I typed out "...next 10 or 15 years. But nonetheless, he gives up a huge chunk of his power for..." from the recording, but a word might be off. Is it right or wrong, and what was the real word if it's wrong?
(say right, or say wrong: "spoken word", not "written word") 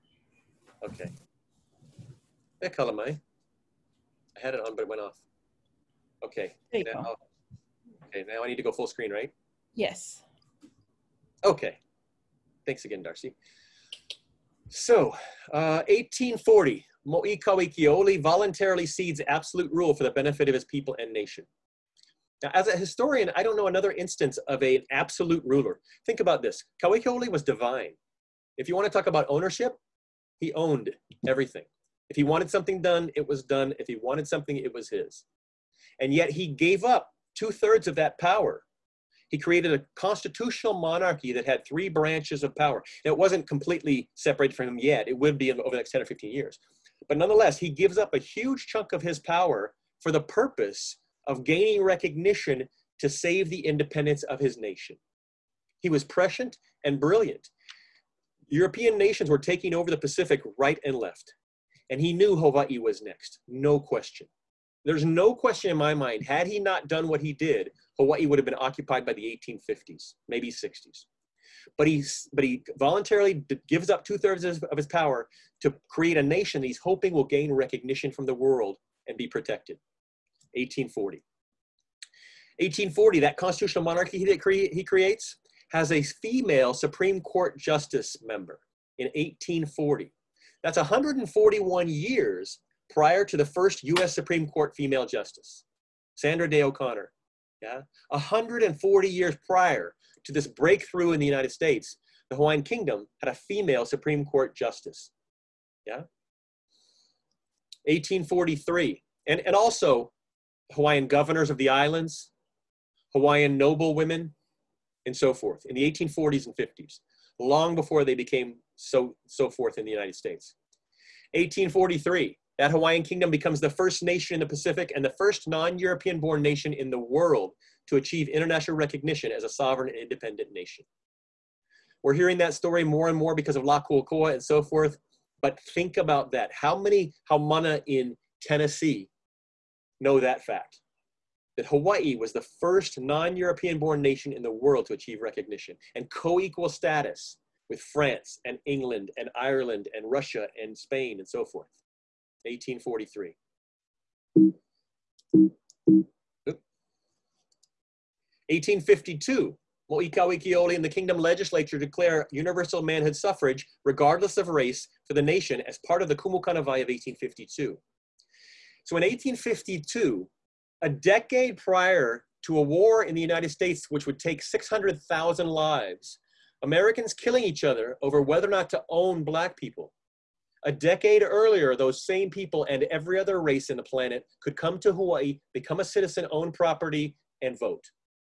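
right.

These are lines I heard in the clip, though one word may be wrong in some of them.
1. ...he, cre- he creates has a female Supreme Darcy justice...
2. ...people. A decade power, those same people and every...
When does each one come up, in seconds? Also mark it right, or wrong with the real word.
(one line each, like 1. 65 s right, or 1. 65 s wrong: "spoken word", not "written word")
1. 84 s wrong: "Court", not "Darcy"
2. 179 s wrong: "earlier", not "power".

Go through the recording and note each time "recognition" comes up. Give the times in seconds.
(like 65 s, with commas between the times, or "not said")
51 s, 77 s, 128 s, 145 s.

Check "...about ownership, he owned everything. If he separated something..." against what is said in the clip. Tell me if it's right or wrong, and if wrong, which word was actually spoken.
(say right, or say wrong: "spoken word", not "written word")
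wrong: "wanted", not "separated".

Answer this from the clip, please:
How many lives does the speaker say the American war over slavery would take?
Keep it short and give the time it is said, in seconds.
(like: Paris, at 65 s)
600,000, at 174 s.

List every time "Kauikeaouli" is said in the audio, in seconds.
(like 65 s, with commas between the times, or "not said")
17 s, 26 s, 160 s.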